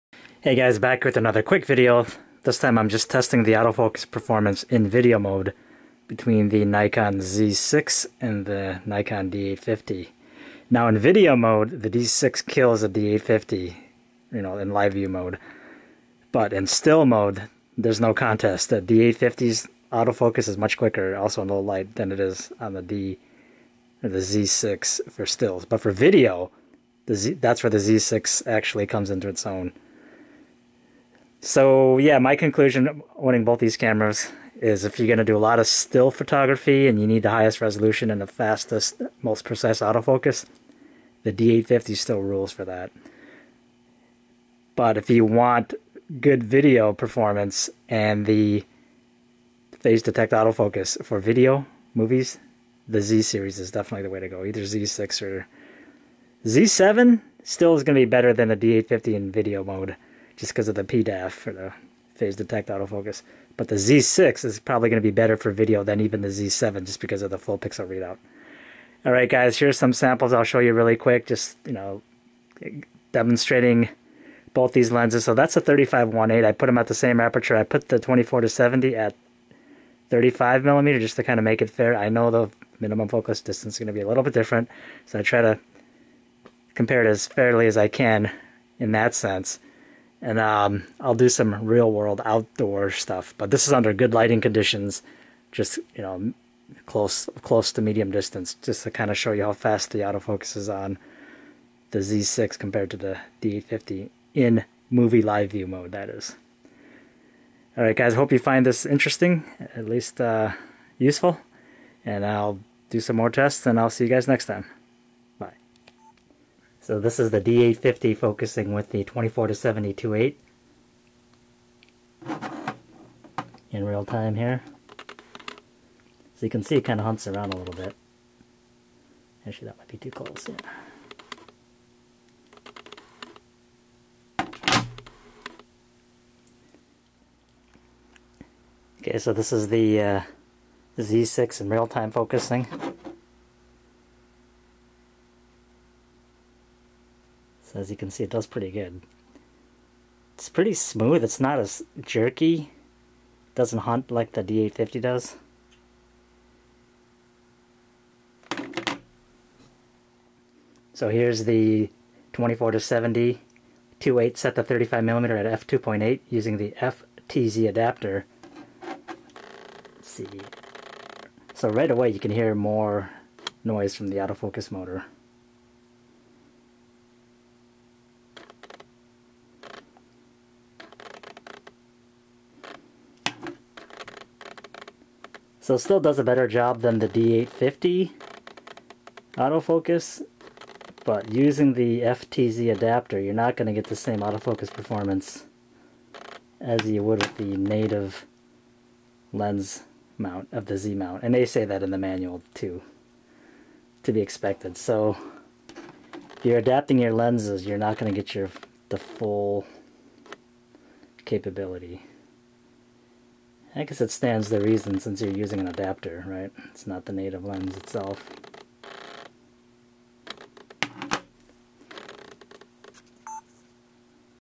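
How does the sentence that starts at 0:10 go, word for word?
Now in video mode, the D6 kills the D850, you know, in live view mode.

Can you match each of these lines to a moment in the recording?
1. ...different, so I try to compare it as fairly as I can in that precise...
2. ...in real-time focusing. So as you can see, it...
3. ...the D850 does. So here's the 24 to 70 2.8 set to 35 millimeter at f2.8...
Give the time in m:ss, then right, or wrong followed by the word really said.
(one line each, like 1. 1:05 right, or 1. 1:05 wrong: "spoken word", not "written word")
1. 1:24 wrong: "sense", not "precise"
2. 2:21 right
3. 2:34 right.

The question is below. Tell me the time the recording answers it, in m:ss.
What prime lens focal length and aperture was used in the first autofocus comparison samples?
1:15.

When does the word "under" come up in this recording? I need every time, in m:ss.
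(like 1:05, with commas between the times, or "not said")
1:33.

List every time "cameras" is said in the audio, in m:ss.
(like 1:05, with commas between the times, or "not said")
0:33.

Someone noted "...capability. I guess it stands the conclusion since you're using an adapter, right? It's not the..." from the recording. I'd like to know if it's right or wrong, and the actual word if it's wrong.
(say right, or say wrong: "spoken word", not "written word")
wrong: "reason", not "conclusion".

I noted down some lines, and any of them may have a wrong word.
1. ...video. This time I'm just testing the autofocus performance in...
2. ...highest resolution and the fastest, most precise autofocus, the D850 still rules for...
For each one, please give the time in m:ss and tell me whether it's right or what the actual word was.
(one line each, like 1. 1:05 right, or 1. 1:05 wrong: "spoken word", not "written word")
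1. 0:01 right
2. 0:37 right.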